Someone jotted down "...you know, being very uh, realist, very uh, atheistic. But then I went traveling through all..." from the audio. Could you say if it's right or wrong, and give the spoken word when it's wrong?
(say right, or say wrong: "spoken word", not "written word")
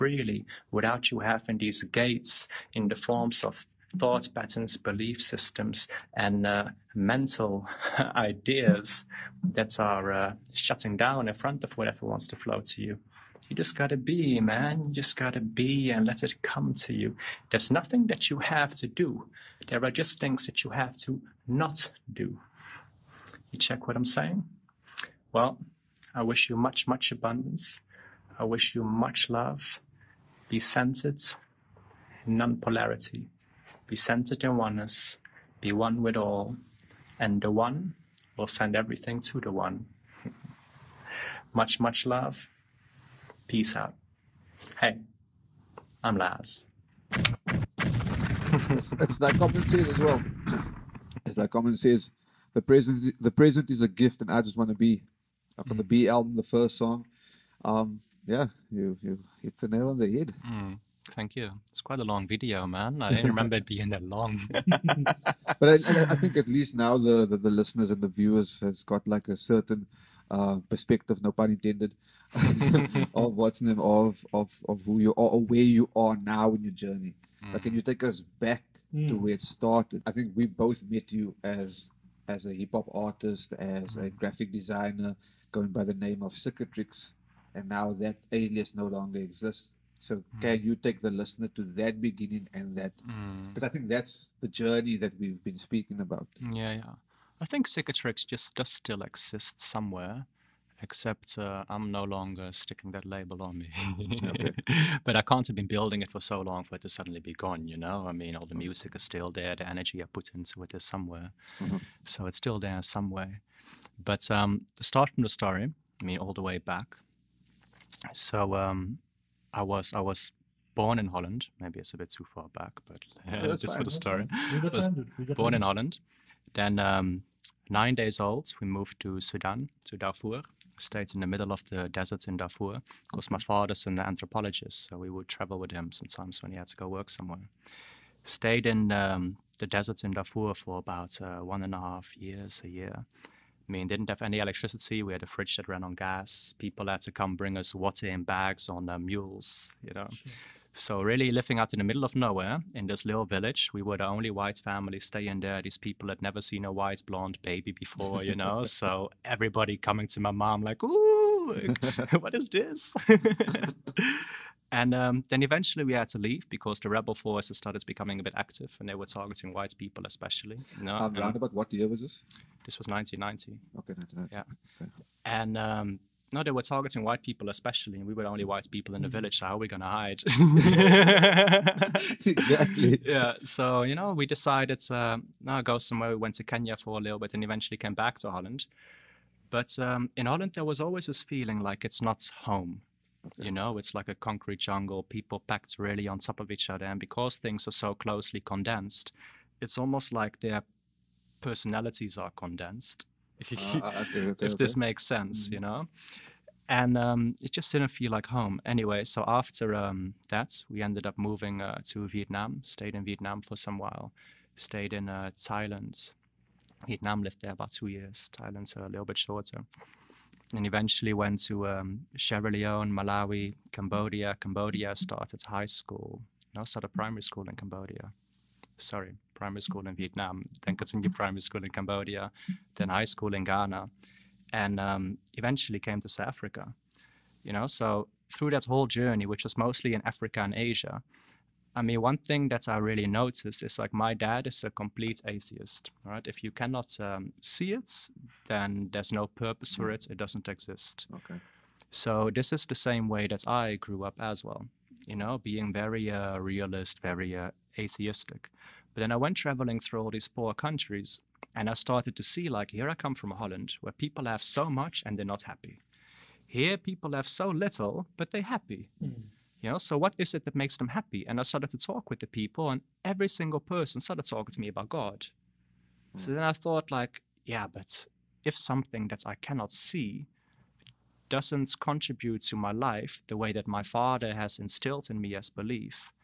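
right.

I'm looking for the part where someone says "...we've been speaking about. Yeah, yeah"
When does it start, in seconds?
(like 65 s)
95 s.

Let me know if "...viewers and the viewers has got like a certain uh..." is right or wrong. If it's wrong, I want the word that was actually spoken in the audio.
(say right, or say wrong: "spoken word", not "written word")
wrong: "listeners", not "viewers".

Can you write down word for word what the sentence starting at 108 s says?
music is still there, the energy I put into it is somewhere.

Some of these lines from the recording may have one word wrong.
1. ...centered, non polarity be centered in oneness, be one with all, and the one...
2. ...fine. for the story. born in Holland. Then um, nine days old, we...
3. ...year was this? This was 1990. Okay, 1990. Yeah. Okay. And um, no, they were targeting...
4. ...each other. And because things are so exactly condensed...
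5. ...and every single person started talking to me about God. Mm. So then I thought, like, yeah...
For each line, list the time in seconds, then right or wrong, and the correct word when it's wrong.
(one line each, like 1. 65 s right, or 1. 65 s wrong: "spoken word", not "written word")
1. 30 s right
2. 123 s right
3. 171 s right
4. 196 s wrong: "closely", not "exactly"
5. 272 s right.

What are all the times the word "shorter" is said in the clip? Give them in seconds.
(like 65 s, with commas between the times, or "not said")
219 s.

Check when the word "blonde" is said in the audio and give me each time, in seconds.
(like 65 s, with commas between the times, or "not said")
157 s.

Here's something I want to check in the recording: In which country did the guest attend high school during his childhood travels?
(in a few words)
Ghana.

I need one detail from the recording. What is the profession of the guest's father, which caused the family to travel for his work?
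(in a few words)
Anthropologist.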